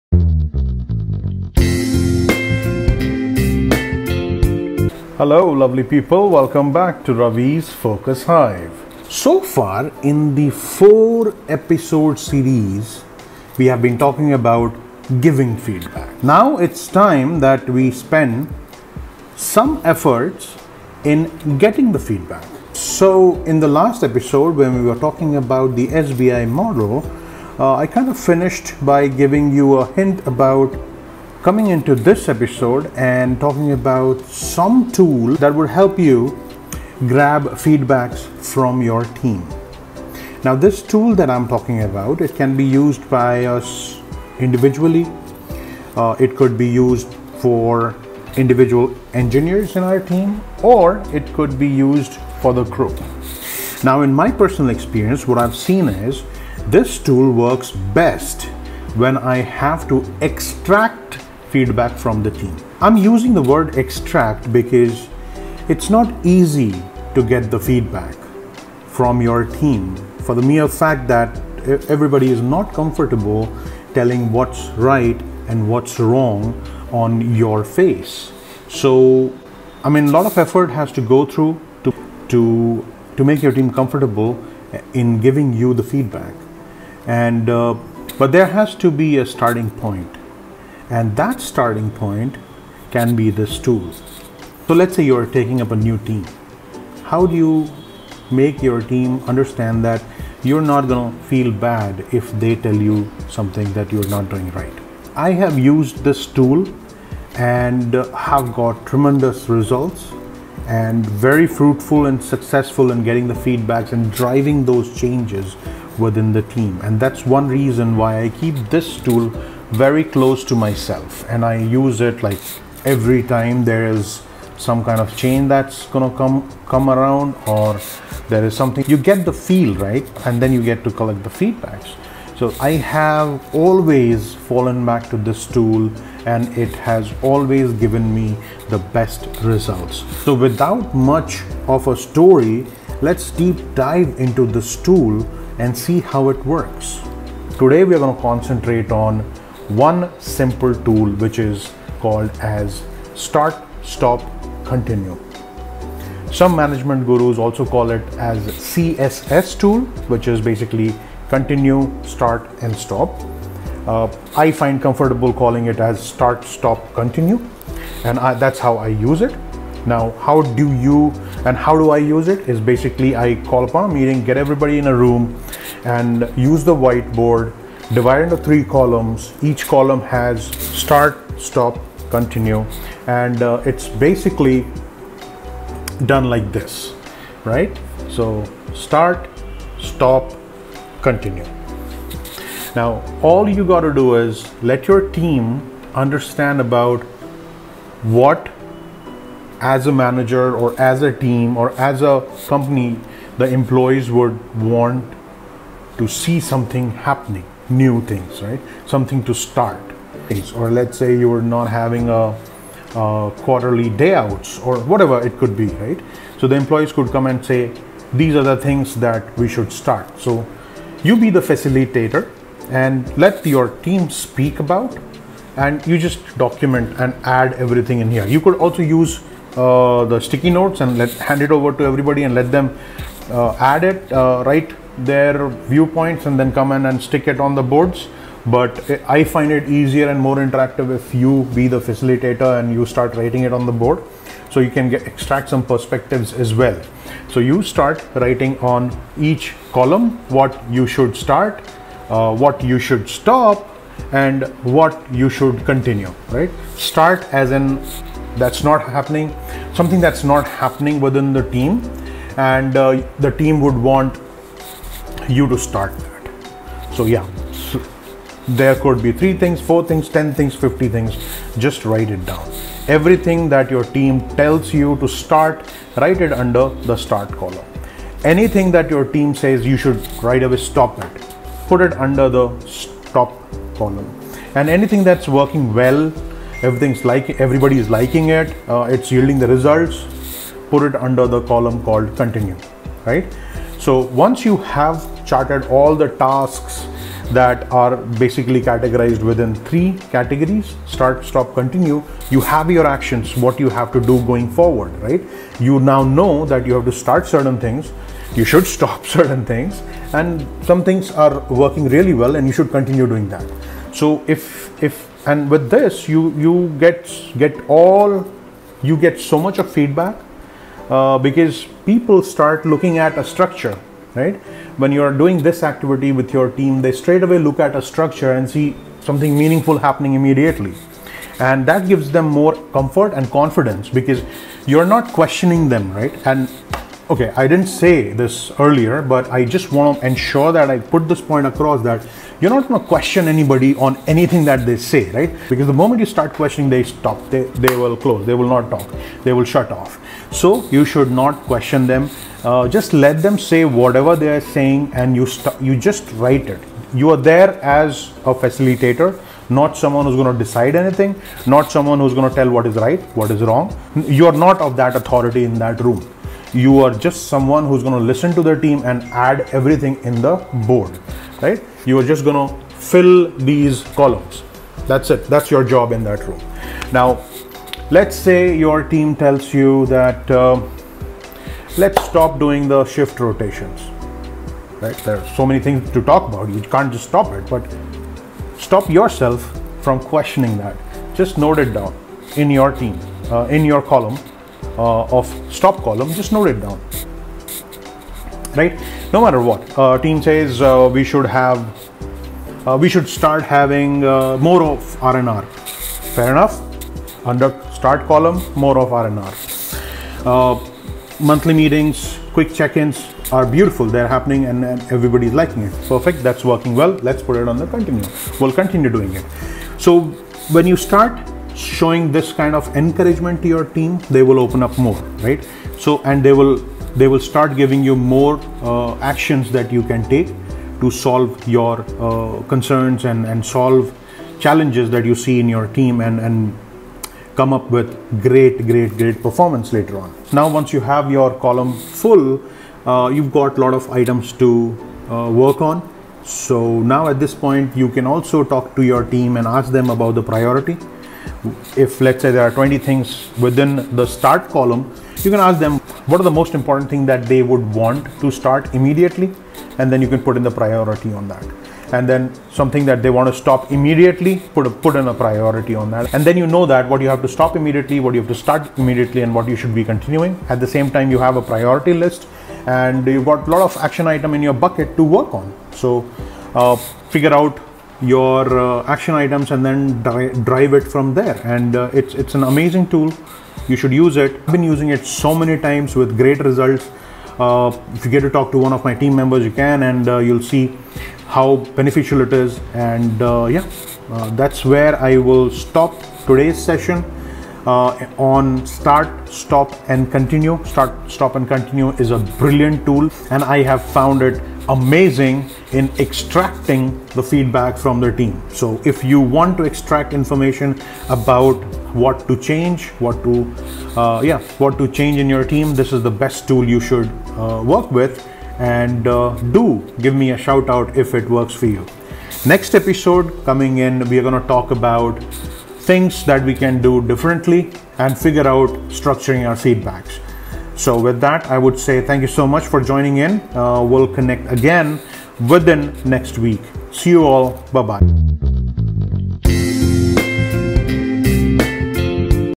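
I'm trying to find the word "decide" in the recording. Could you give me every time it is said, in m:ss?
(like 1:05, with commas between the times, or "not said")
6:00.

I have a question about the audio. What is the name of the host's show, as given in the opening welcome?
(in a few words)
Ravi's Focus Hive.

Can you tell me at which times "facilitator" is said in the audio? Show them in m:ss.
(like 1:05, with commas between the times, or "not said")
3:41, 4:01, 5:58.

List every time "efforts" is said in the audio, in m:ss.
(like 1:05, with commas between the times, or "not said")
0:19, 1:20.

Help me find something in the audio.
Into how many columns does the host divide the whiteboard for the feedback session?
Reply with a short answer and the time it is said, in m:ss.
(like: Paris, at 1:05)
3, at 2:58.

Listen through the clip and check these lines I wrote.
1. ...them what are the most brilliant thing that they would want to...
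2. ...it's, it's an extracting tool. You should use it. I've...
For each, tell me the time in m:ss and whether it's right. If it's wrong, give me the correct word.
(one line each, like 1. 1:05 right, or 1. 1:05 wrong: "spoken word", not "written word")
1. 7:35 wrong: "important", not "brilliant"
2. 8:01 wrong: "amazing", not "extracting".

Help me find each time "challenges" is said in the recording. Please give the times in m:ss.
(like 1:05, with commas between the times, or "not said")
7:14.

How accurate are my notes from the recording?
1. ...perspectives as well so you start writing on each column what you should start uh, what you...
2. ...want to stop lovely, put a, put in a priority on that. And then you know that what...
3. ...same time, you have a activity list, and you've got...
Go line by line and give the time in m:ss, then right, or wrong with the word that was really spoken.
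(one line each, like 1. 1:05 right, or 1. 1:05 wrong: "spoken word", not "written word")
1. 4:05 right
2. 7:43 wrong: "immediately", not "lovely"
3. 7:50 wrong: "priority", not "activity".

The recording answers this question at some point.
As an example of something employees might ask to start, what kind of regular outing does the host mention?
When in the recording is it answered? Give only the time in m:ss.
3:33.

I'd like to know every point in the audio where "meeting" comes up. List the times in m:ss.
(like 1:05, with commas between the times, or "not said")
2:53, 6:51.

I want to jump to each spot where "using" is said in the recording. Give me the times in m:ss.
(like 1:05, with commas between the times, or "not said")
1:02, 8:04.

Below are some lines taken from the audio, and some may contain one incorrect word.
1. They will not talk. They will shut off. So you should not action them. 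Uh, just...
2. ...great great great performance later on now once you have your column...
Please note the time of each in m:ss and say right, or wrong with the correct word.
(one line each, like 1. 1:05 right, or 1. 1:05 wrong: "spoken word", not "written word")
1. 5:48 wrong: "question", not "action"
2. 7:18 right.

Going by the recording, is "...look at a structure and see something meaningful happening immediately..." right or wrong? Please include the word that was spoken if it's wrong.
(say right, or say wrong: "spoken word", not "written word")
right.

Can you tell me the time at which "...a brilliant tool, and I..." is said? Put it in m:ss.
8:22.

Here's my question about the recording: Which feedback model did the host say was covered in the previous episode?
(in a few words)
SBI model.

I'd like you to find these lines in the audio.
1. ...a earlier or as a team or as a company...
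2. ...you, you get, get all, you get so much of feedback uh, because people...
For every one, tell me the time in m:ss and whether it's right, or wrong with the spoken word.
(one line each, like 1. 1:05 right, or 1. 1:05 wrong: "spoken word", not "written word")
1. 3:19 wrong: "manager", not "earlier"
2. 5:16 right.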